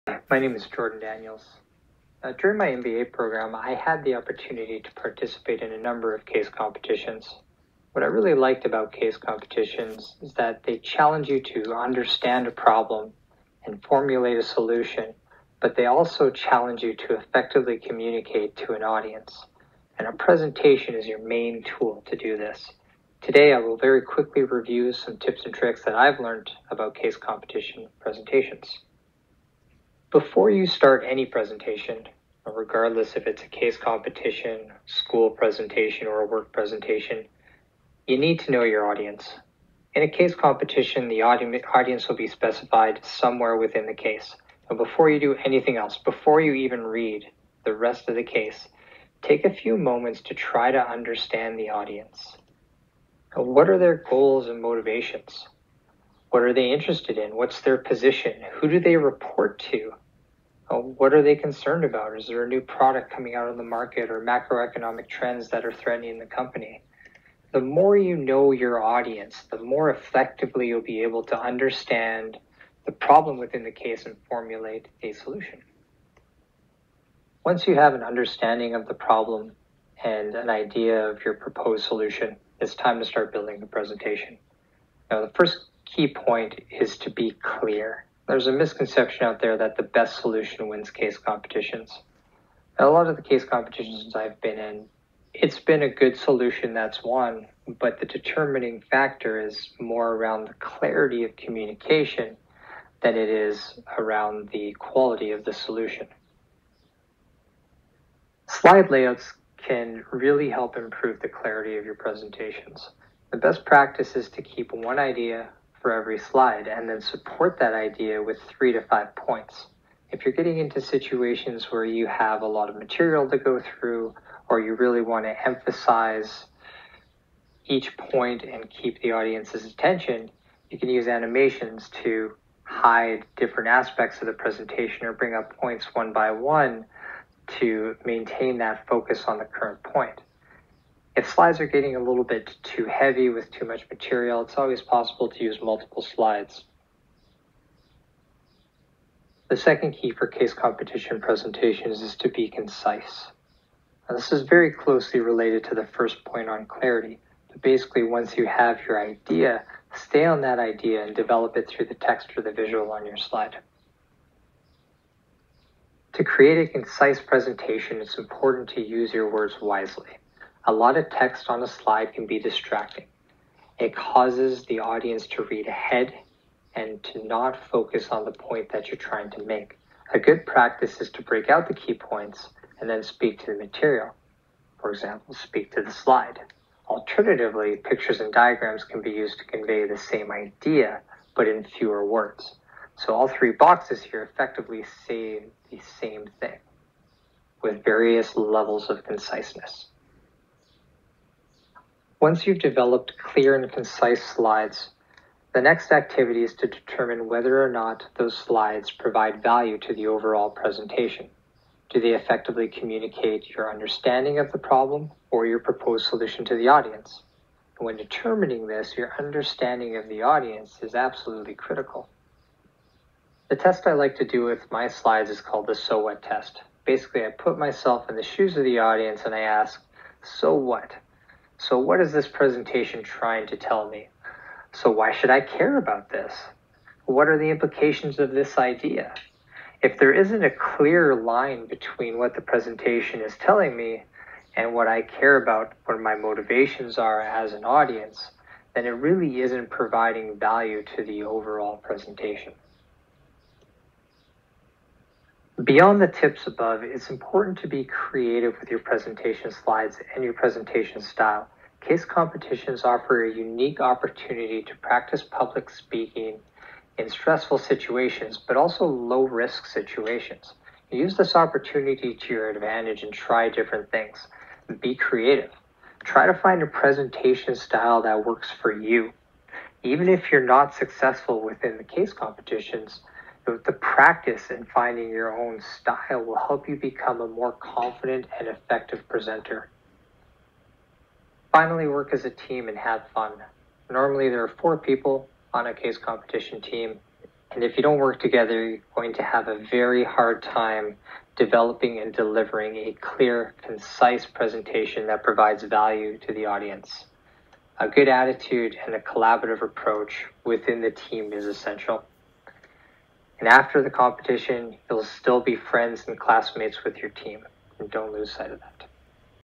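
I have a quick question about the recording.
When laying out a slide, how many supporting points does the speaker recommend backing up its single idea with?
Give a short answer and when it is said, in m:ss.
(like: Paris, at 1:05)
3 to 5, at 1:58.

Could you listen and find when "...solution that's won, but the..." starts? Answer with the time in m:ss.
1:36.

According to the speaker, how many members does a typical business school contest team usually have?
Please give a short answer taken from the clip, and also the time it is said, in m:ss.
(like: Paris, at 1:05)
4, at 4:54.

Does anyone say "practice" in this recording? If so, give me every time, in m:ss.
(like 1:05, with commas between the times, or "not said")
1:53, 3:00, 4:24, 4:43.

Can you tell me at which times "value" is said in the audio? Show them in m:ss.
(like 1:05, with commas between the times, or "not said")
3:29, 4:10, 5:05.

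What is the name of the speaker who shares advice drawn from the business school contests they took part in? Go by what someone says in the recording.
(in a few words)
Jordan Daniels.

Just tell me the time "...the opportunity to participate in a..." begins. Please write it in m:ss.
0:04.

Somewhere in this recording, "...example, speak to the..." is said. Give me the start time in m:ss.
3:04.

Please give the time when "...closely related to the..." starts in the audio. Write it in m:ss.
2:34.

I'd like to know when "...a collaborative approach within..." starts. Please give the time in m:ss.
5:08.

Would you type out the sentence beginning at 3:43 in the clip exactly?
The test I like to do with my slides is called the so what test.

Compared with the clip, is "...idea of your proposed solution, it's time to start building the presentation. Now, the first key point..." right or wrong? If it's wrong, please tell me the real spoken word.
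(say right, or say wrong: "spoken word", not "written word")
right.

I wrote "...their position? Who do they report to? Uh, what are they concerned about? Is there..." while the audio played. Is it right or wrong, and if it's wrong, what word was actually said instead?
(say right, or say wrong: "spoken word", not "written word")
right.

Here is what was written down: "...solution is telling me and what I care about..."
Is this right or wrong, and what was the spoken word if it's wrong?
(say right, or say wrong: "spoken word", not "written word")
wrong: "presentation", not "solution".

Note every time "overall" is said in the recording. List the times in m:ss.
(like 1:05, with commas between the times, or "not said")
3:30, 4:11.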